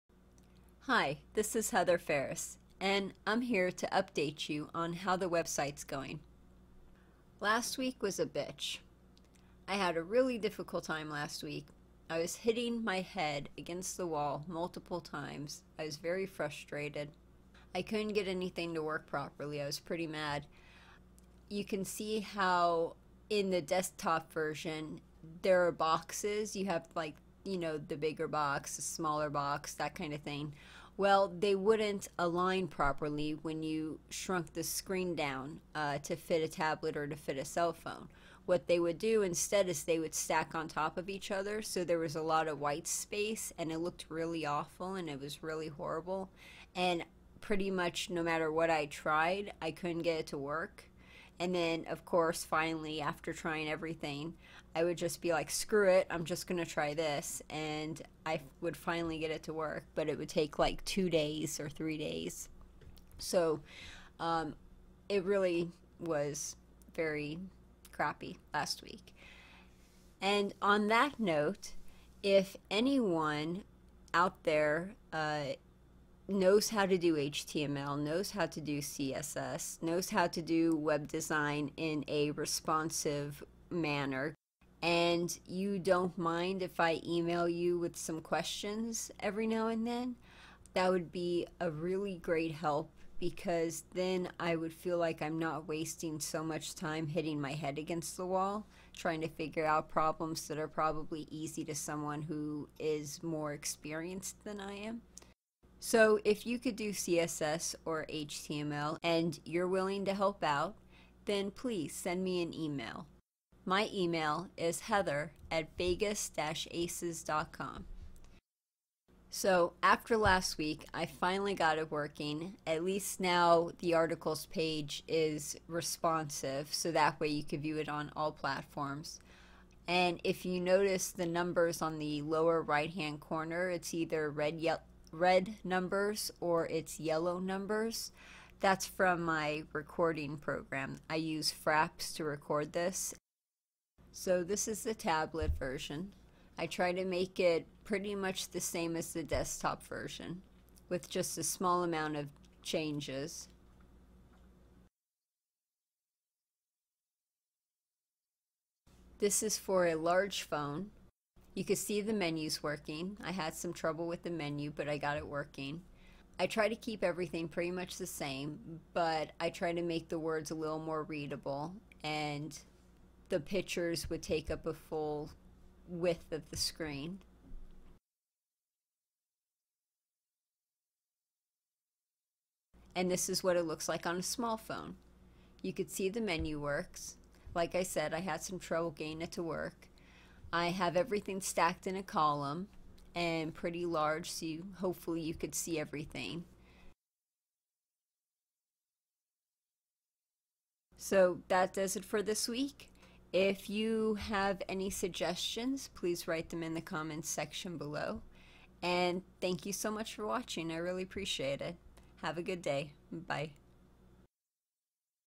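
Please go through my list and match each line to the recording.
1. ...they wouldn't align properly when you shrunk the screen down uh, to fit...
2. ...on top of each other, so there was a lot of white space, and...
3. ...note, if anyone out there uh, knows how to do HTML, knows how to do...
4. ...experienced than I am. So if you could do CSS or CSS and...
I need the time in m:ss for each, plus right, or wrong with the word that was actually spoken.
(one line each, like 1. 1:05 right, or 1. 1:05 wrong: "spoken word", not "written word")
1. 0:31 right
2. 0:40 right
3. 1:11 right
4. 1:43 wrong: "HTML", not "CSS".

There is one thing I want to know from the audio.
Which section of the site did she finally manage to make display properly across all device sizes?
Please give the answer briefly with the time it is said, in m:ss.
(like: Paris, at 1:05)
the articles page, at 2:03.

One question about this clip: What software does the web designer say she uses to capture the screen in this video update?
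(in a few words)
Fraps.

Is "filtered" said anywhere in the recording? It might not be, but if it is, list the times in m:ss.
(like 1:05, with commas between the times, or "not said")
not said.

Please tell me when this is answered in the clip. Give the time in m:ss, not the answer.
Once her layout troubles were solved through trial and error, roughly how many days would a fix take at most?
1:01.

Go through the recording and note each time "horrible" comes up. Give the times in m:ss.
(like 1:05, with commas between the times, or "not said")
0:45.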